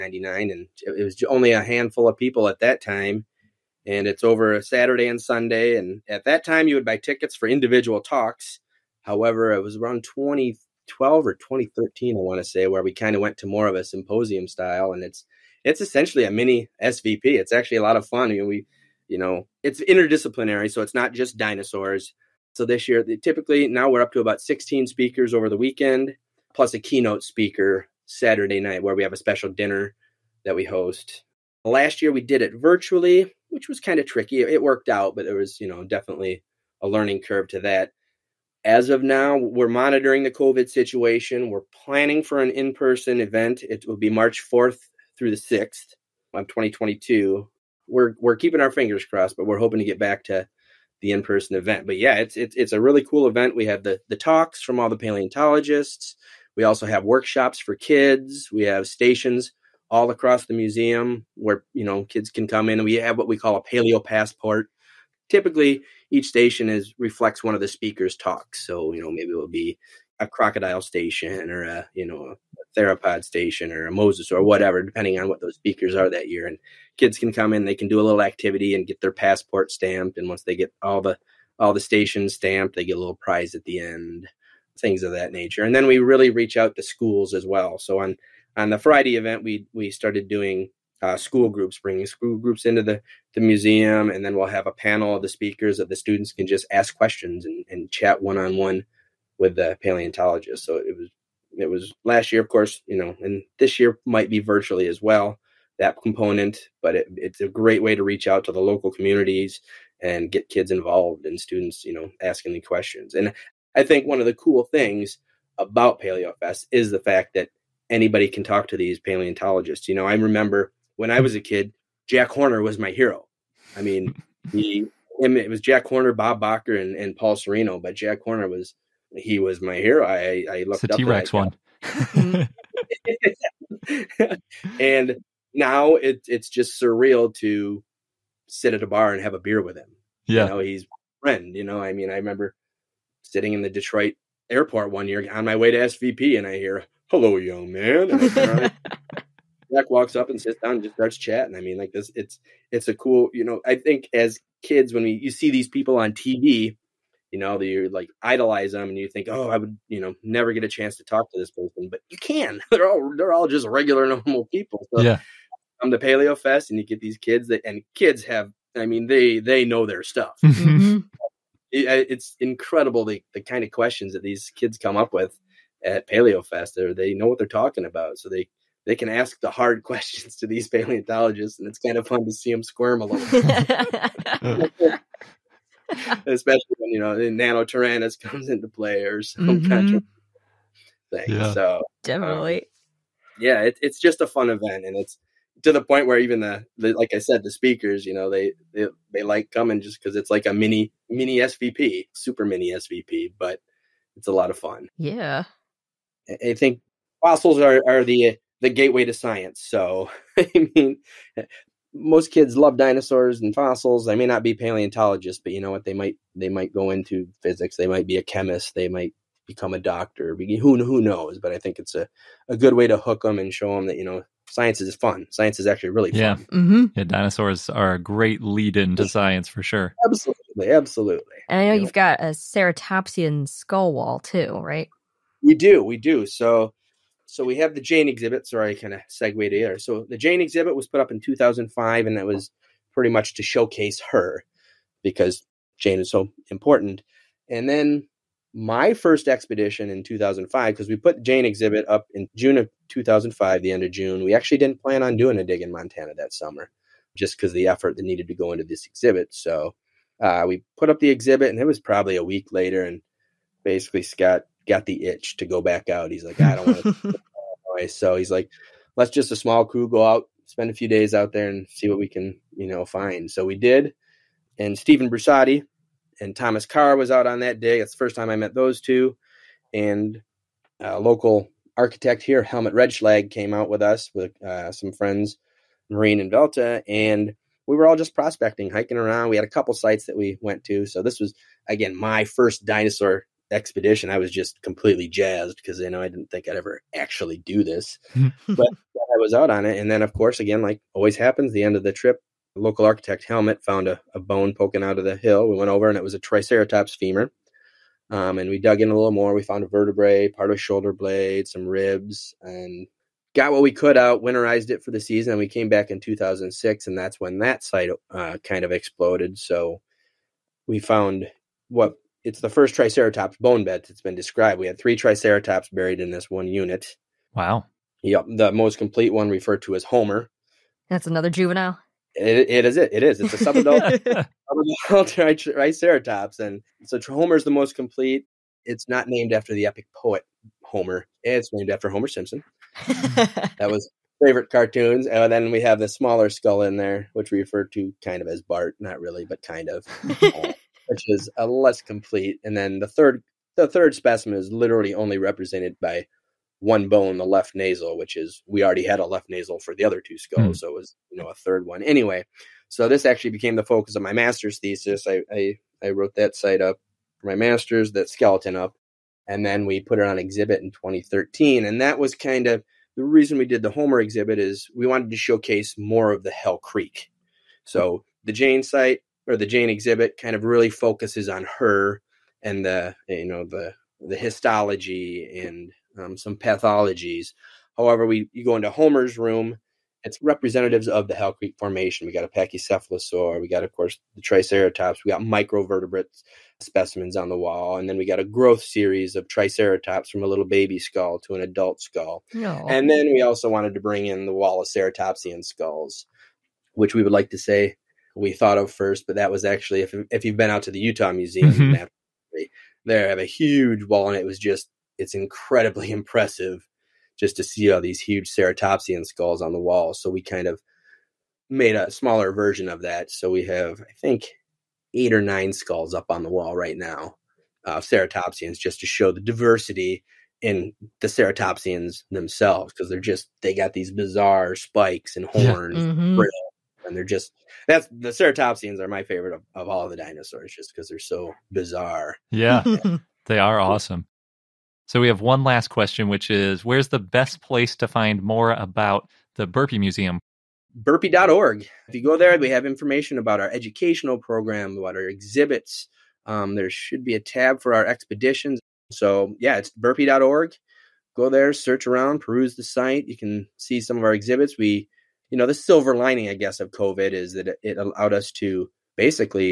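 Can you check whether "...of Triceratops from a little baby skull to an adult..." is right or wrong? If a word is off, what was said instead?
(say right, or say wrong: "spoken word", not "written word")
right.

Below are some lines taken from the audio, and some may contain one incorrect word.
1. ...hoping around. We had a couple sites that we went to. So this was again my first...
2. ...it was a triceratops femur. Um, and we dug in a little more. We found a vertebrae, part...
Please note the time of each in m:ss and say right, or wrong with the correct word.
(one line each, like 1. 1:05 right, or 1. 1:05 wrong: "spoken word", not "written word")
1. 4:48 wrong: "hiking", not "hoping"
2. 5:05 right.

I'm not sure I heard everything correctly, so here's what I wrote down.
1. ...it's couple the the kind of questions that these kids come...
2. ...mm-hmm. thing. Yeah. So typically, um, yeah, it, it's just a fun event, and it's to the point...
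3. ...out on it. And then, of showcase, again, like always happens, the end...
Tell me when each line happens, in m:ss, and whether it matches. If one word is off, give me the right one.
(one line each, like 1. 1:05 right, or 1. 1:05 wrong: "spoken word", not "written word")
1. 2:52 wrong: "incredible", not "couple"
2. 3:10 wrong: "definitely", not "typically"
3. 4:59 wrong: "course", not "showcase".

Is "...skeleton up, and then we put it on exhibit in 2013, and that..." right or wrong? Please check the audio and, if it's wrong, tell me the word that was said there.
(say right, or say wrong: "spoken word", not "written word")
right.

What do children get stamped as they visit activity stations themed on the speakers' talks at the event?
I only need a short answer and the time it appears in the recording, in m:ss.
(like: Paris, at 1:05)
paleo passport, at 1:03.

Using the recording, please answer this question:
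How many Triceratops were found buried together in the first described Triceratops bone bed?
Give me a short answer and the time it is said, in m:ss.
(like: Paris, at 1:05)
3, at 5:24.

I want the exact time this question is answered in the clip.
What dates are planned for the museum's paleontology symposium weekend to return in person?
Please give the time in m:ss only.
0:44.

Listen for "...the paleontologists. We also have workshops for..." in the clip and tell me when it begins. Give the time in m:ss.
0:54.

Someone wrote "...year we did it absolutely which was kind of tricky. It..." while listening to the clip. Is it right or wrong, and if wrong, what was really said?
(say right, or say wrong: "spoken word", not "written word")
wrong: "virtually", not "absolutely".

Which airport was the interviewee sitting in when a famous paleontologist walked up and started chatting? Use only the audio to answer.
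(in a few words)
Detroit airport.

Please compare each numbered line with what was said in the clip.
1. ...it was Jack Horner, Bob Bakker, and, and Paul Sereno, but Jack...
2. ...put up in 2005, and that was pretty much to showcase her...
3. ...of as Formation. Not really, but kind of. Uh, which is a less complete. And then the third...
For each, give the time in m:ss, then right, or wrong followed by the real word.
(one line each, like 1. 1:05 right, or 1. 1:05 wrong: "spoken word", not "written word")
1. 2:05 right
2. 4:00 right
3. 5:48 wrong: "Bart", not "Formation".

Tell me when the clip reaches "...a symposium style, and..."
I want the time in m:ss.
0:13.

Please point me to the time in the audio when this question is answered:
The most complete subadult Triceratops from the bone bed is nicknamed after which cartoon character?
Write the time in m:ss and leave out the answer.
5:41.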